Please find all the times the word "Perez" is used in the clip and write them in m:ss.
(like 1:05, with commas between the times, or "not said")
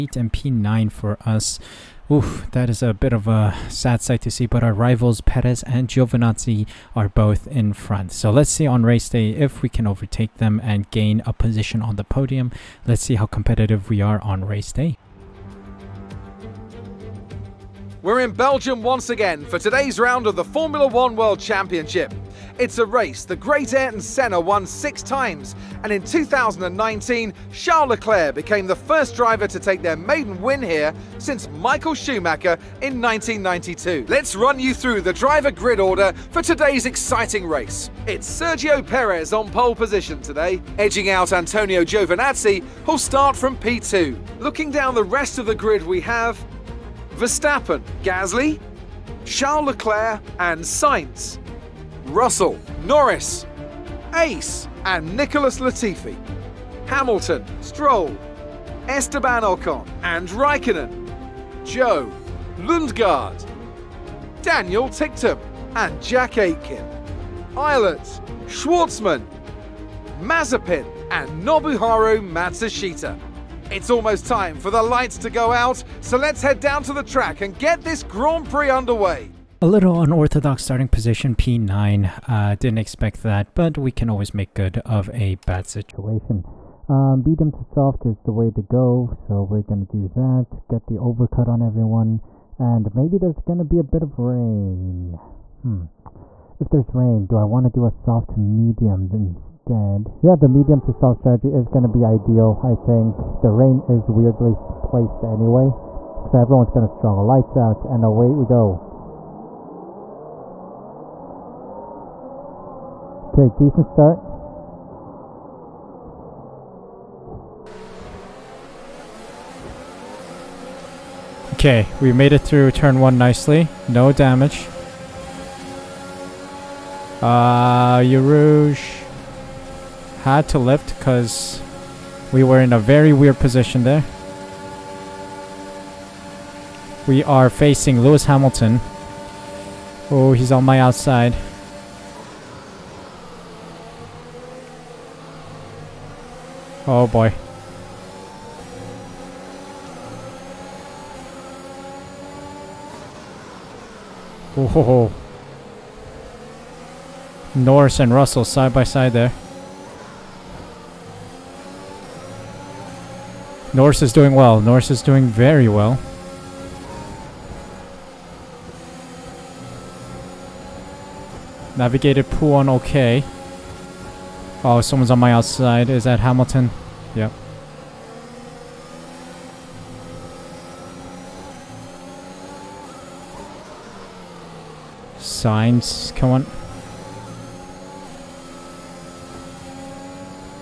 0:05, 0:38.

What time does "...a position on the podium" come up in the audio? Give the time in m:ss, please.
0:11.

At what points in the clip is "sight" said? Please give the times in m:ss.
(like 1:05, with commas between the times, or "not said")
0:04.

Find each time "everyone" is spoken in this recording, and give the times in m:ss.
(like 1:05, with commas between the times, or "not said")
1:31, 1:46.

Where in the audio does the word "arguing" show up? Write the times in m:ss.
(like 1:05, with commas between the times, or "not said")
not said.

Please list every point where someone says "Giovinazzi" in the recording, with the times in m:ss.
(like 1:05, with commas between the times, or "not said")
0:05, 0:41.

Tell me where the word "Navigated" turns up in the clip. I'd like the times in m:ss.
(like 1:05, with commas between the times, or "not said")
2:51.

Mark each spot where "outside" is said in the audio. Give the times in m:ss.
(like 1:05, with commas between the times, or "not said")
2:20, 2:55.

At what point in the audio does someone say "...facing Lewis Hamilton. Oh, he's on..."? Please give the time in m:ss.
2:17.